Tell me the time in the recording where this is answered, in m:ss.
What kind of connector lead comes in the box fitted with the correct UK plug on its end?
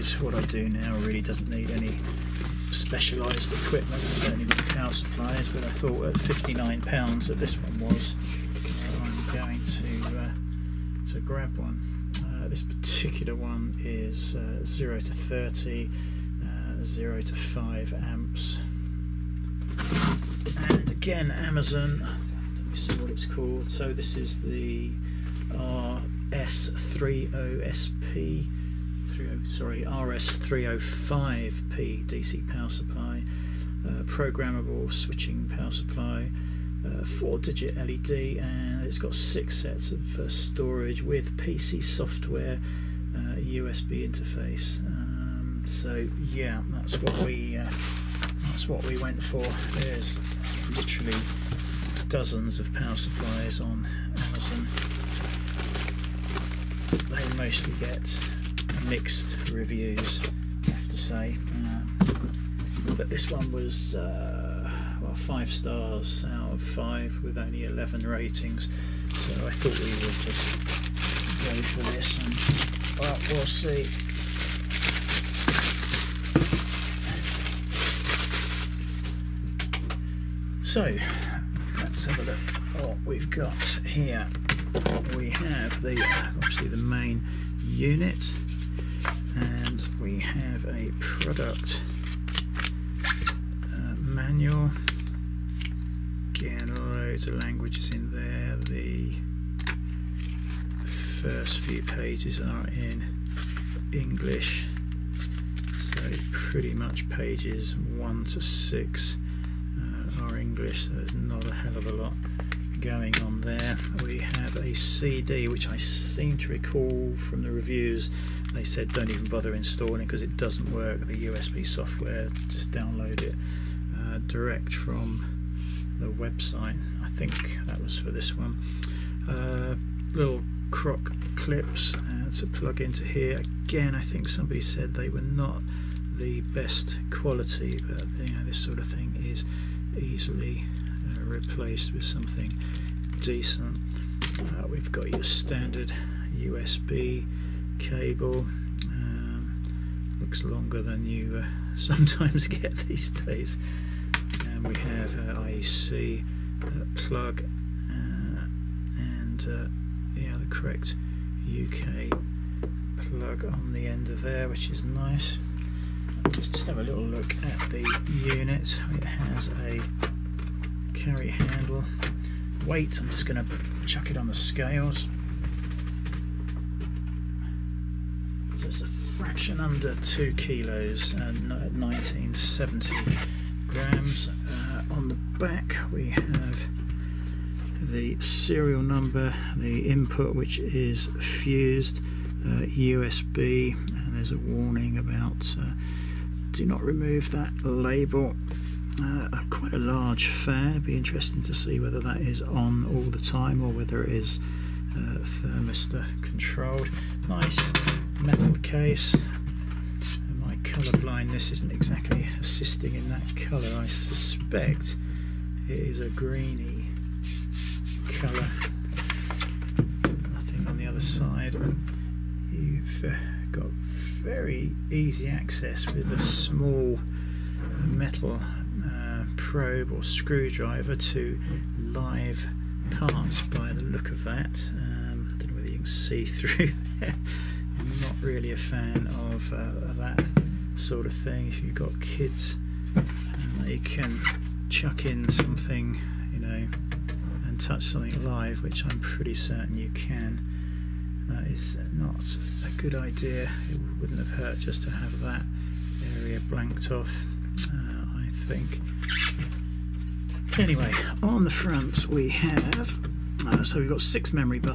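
2:35.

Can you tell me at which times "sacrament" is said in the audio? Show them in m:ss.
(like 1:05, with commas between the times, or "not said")
not said.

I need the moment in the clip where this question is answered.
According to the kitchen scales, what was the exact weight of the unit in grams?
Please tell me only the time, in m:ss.
3:01.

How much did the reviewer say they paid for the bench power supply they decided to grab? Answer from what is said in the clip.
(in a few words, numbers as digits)
£59.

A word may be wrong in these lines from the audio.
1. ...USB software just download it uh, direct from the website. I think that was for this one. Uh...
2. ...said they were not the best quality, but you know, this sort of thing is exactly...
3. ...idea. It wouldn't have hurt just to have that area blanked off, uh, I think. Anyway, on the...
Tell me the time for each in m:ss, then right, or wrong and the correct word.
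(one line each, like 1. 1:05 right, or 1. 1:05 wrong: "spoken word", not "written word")
1. 2:01 right
2. 2:14 wrong: "easily", not "exactly"
3. 4:12 right.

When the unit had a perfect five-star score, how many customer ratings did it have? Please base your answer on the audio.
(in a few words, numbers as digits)
11.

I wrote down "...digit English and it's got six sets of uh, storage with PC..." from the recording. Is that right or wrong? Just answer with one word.
wrong.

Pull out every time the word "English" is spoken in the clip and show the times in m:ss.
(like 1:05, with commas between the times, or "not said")
1:43, 1:50.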